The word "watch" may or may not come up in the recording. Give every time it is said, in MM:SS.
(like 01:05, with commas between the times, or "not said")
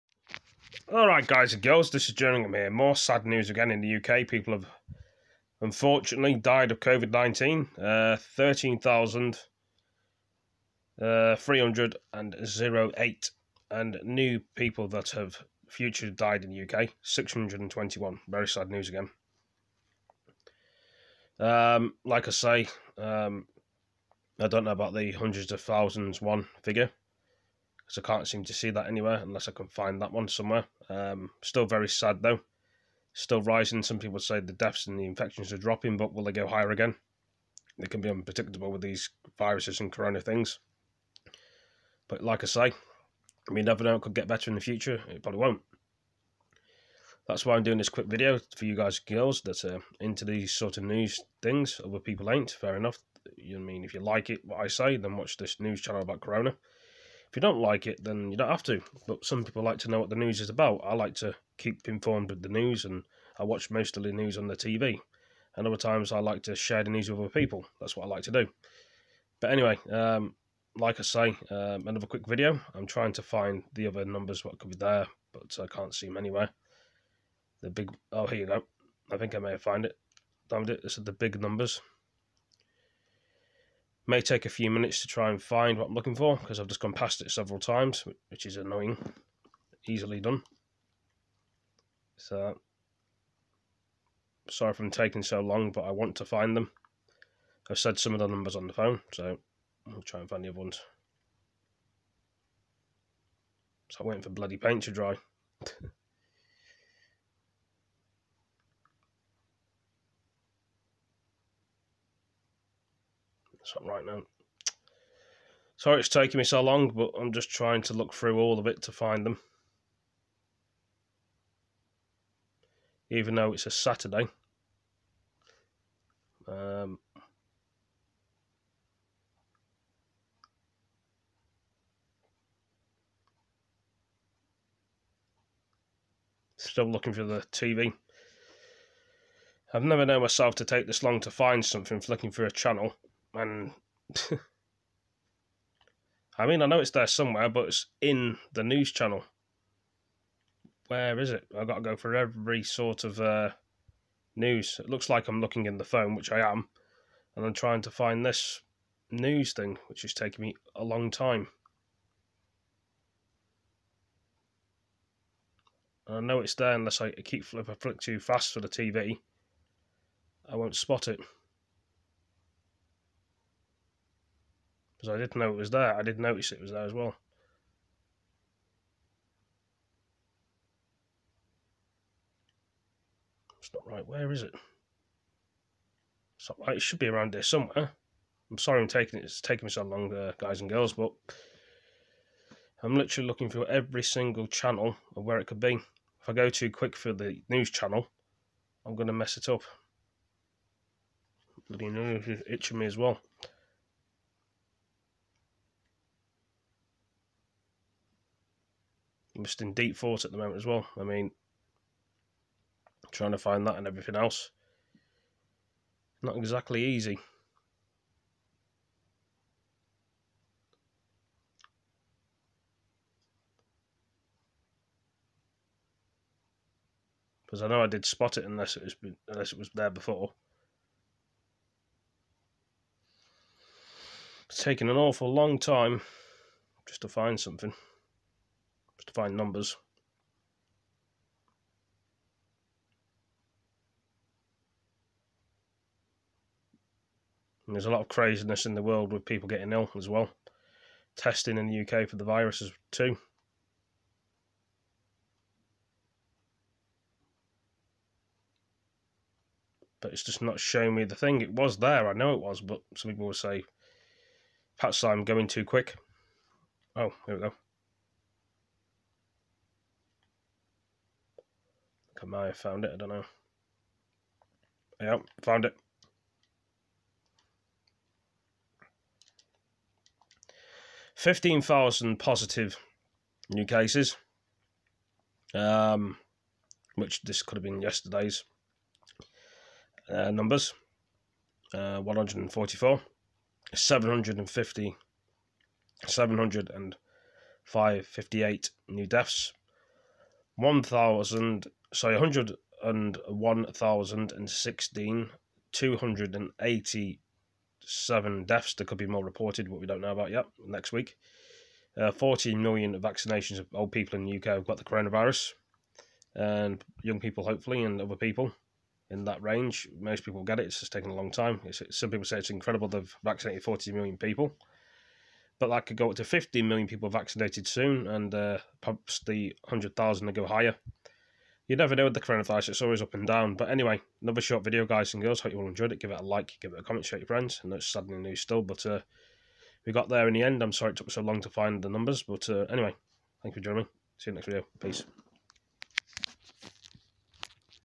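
00:55, 01:03.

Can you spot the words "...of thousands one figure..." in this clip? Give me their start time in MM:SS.
00:25.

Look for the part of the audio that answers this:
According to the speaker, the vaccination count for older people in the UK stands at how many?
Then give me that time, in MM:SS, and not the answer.
05:12.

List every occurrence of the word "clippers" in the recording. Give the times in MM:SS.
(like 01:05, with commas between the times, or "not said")
not said.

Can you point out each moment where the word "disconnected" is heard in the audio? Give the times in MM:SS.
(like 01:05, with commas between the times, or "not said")
not said.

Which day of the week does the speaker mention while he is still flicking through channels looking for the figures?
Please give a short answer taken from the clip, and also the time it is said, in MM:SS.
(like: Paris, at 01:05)
Saturday, at 02:03.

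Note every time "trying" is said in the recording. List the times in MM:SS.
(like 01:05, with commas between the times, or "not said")
01:12, 01:57, 02:37, 03:33.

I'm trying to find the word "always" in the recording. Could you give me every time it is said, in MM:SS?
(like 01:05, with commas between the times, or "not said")
05:32.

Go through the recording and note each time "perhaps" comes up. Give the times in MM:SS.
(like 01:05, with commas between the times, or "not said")
04:24, 05:28.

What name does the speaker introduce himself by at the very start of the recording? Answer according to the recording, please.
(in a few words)
Jerningham.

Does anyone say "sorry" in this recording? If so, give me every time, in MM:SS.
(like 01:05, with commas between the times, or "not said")
01:34, 01:55, 03:08, 05:01, 05:40.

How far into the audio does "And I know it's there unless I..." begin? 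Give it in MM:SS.
02:46.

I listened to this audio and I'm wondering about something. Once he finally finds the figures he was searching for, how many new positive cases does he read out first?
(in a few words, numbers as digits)
15,000.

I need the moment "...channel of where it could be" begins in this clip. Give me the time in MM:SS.
03:14.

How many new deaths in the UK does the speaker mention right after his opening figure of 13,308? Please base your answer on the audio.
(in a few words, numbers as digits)
621.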